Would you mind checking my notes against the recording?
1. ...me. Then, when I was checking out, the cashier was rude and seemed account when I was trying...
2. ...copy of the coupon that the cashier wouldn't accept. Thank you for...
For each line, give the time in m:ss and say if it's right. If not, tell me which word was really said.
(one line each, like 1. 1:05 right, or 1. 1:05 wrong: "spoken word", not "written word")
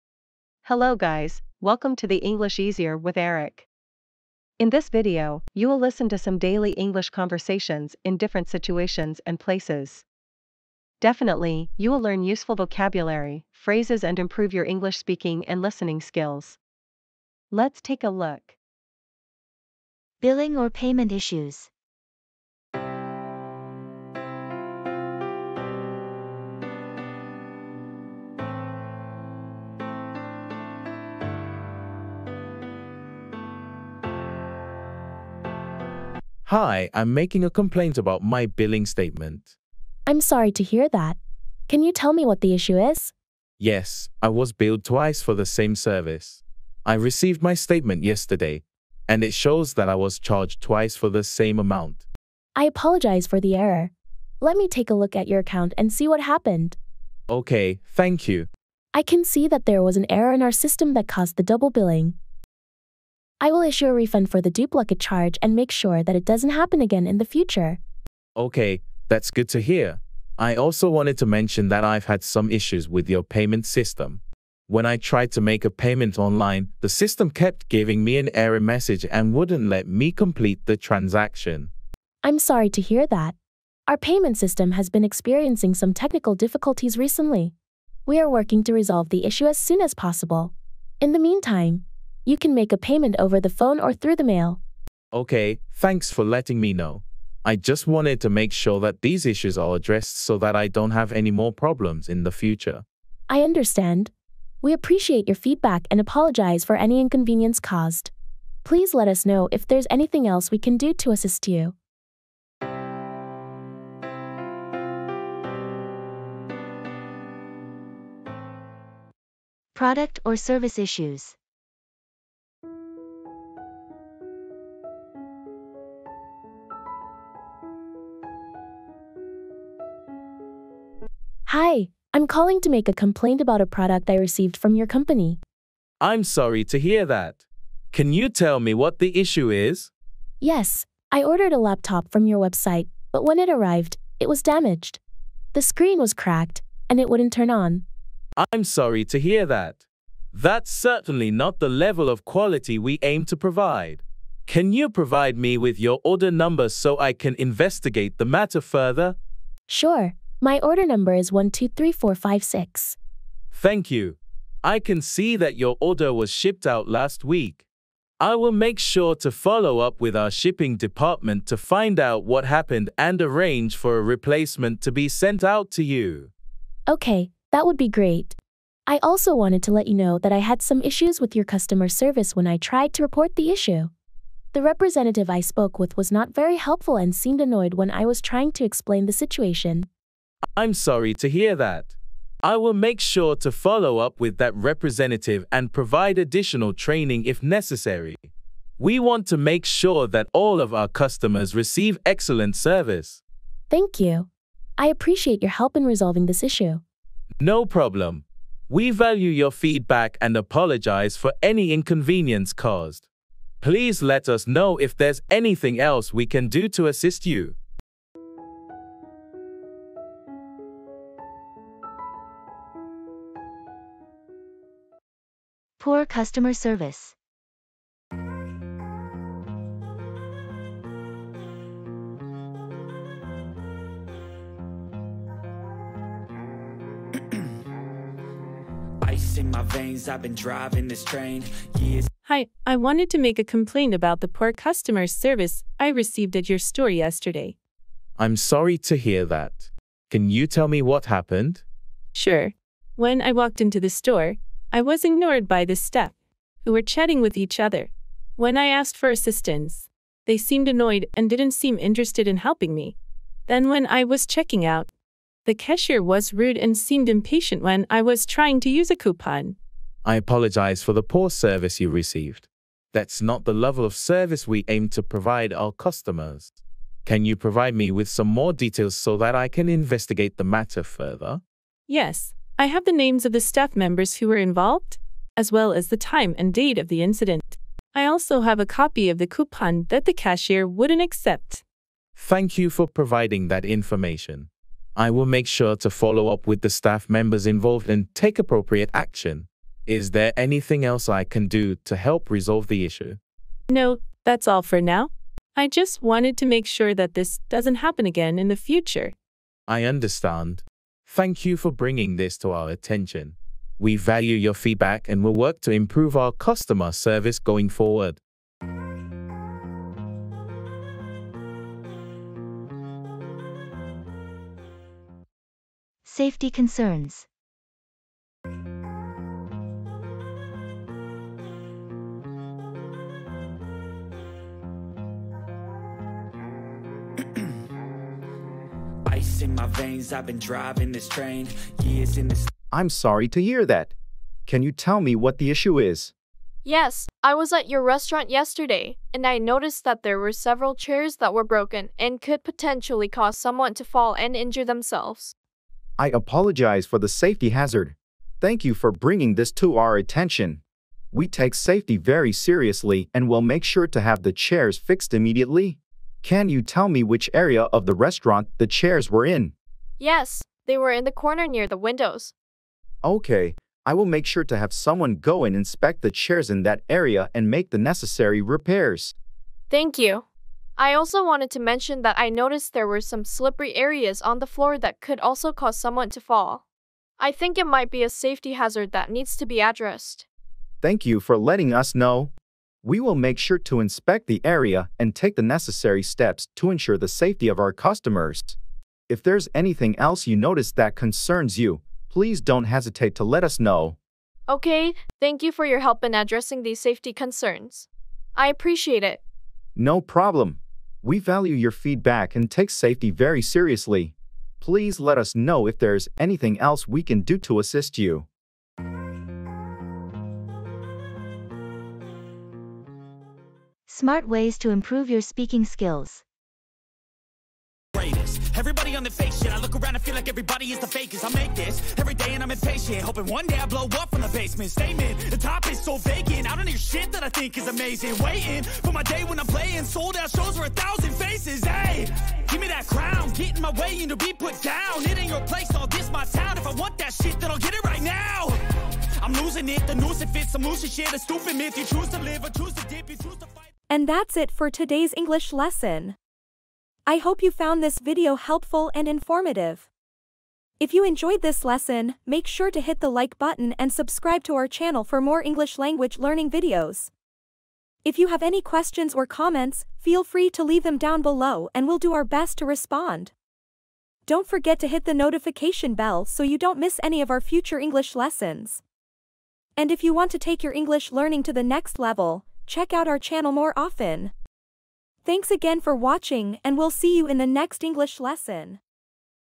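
1. 4:22 wrong: "impatient", not "account"
2. 4:48 right.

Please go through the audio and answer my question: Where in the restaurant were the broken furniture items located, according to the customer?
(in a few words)
near the windows.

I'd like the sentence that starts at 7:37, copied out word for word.
I hope you found this video helpful and informative.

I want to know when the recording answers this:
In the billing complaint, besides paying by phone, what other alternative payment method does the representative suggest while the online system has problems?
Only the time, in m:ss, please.
1:33.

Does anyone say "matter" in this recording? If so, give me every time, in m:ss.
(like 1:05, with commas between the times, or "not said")
2:38, 4:40.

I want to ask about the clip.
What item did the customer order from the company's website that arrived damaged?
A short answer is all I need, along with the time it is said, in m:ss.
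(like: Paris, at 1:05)
laptop, at 2:21.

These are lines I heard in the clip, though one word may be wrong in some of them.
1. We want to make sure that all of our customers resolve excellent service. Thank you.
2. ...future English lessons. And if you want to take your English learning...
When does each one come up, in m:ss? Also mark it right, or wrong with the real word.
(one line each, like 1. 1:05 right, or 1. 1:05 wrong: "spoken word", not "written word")
1. 3:18 wrong: "receive", not "resolve"
2. 7:57 right.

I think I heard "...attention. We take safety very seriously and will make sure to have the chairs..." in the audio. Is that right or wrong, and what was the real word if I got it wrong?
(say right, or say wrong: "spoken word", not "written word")
right.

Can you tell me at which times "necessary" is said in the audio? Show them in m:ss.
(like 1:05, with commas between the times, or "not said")
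3:17, 6:17, 6:35.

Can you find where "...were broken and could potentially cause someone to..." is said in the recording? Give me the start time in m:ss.
5:51.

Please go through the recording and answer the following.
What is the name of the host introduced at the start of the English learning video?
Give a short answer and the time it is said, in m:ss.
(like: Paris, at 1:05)
Eric, at 0:03.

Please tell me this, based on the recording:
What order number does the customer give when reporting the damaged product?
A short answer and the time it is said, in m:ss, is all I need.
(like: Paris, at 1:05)
123456, at 2:41.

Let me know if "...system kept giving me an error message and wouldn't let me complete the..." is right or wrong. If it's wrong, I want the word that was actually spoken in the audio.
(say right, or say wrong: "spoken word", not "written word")
right.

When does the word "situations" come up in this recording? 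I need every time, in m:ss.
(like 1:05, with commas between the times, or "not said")
0:08, 3:09.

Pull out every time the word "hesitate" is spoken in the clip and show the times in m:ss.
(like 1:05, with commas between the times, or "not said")
6:42.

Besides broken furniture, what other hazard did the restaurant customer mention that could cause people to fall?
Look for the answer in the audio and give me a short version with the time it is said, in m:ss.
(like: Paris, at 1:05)
slippery areas on the floor, at 6:23.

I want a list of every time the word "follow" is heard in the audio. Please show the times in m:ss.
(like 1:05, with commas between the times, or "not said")
2:49, 3:13, 4:55.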